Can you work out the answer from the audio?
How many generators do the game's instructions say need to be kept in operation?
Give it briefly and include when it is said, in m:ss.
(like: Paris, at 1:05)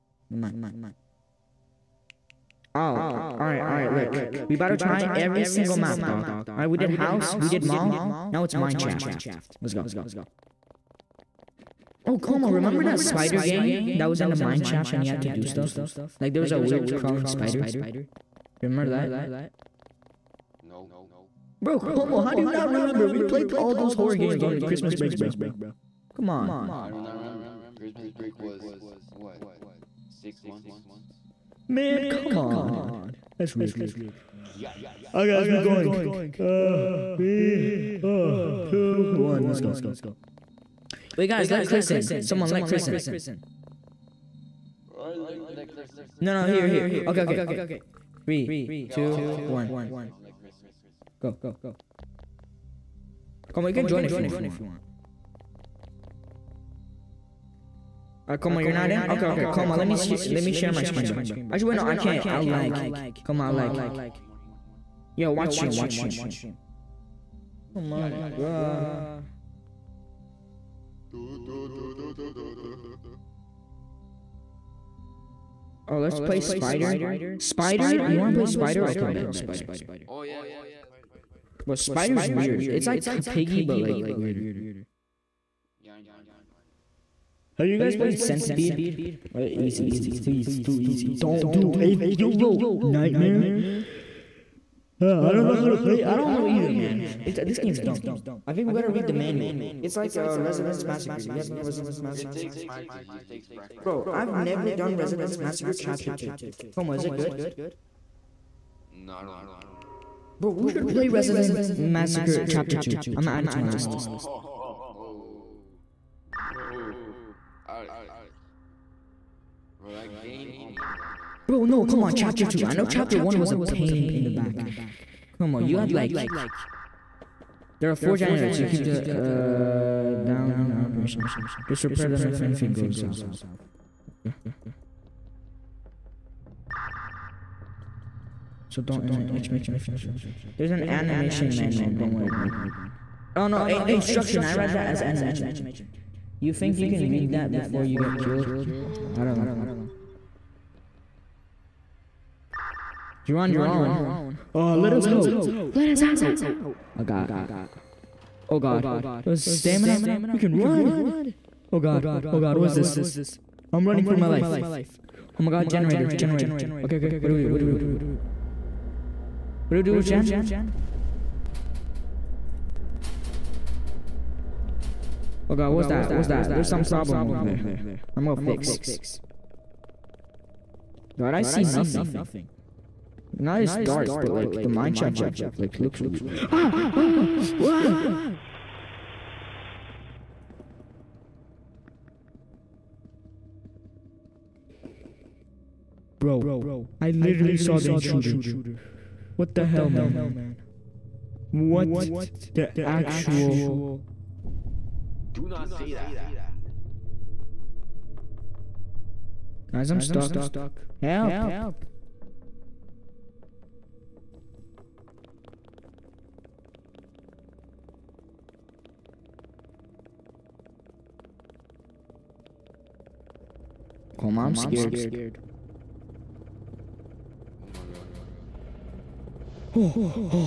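4, at 2:07.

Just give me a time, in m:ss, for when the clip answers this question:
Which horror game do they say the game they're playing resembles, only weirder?
1:23.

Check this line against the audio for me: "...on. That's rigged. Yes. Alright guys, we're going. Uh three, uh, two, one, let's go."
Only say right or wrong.
right.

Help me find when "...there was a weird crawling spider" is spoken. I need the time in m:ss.
0:16.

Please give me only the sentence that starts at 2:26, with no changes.
You think you can read that before you get killed?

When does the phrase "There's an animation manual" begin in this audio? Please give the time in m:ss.
2:20.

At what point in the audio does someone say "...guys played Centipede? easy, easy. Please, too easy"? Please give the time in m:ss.
1:27.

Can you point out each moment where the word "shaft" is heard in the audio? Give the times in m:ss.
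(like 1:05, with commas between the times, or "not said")
0:08, 0:14, 3:04.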